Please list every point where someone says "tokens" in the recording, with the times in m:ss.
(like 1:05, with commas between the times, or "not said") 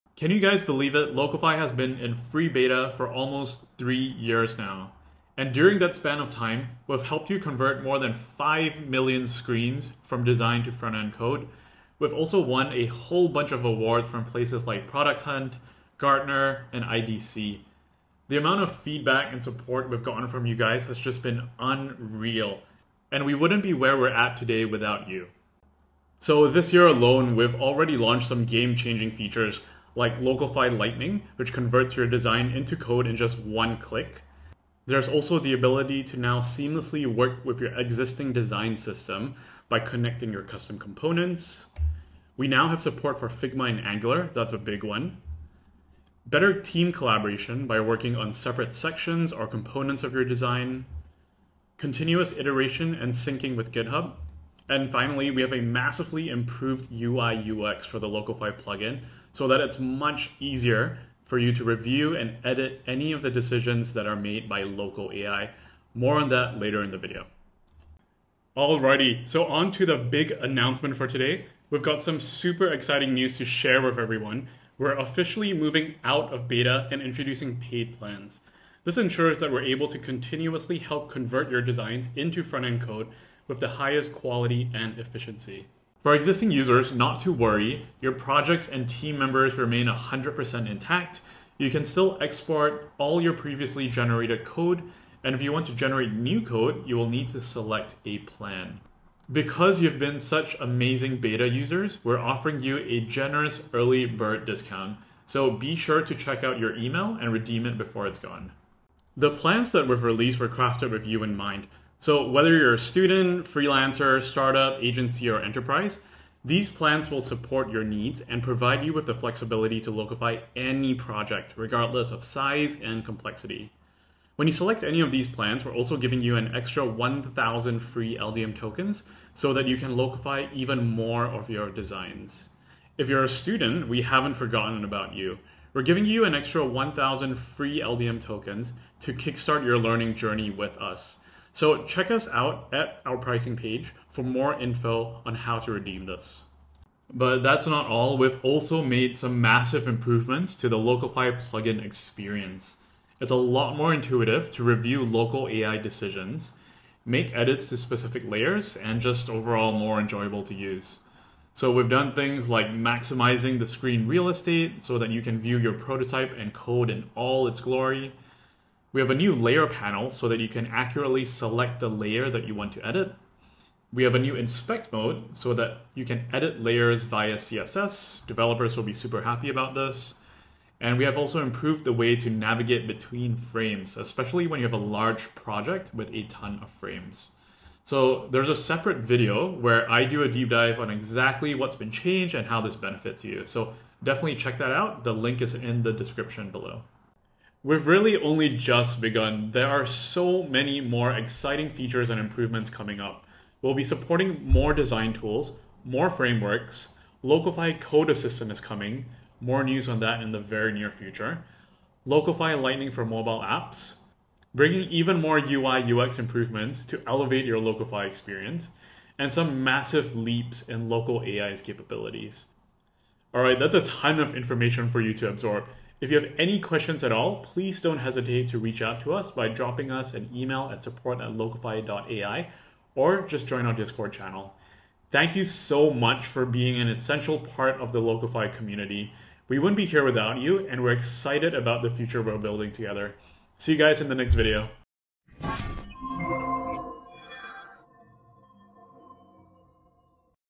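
2:08, 2:18.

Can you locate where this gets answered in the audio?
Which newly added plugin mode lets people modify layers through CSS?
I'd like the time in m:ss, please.
2:54.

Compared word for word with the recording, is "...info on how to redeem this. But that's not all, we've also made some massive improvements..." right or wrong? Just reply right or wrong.
right.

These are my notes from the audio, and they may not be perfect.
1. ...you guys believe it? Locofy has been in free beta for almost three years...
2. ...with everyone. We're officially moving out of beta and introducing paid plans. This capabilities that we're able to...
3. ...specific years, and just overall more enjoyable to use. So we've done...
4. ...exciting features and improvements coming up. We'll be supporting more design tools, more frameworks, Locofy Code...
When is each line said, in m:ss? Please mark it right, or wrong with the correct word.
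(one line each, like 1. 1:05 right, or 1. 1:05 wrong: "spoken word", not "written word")
1. 0:00 right
2. 1:13 wrong: "ensures", not "capabilities"
3. 2:37 wrong: "layers", not "years"
4. 3:21 right.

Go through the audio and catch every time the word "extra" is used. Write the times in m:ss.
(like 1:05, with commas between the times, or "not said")
2:06, 2:16.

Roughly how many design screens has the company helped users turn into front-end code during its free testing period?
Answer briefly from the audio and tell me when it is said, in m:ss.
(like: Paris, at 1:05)
5 million, at 0:08.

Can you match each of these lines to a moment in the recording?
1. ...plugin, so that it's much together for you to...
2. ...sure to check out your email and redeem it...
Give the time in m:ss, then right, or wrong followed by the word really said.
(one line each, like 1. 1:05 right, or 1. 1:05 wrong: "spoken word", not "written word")
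1. 0:58 wrong: "easier", not "together"
2. 1:45 right.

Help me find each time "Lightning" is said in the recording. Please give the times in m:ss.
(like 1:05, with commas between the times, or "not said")
0:30, 3:32.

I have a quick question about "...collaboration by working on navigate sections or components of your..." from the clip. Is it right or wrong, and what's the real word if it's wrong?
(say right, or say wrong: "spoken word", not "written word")
wrong: "separate", not "navigate".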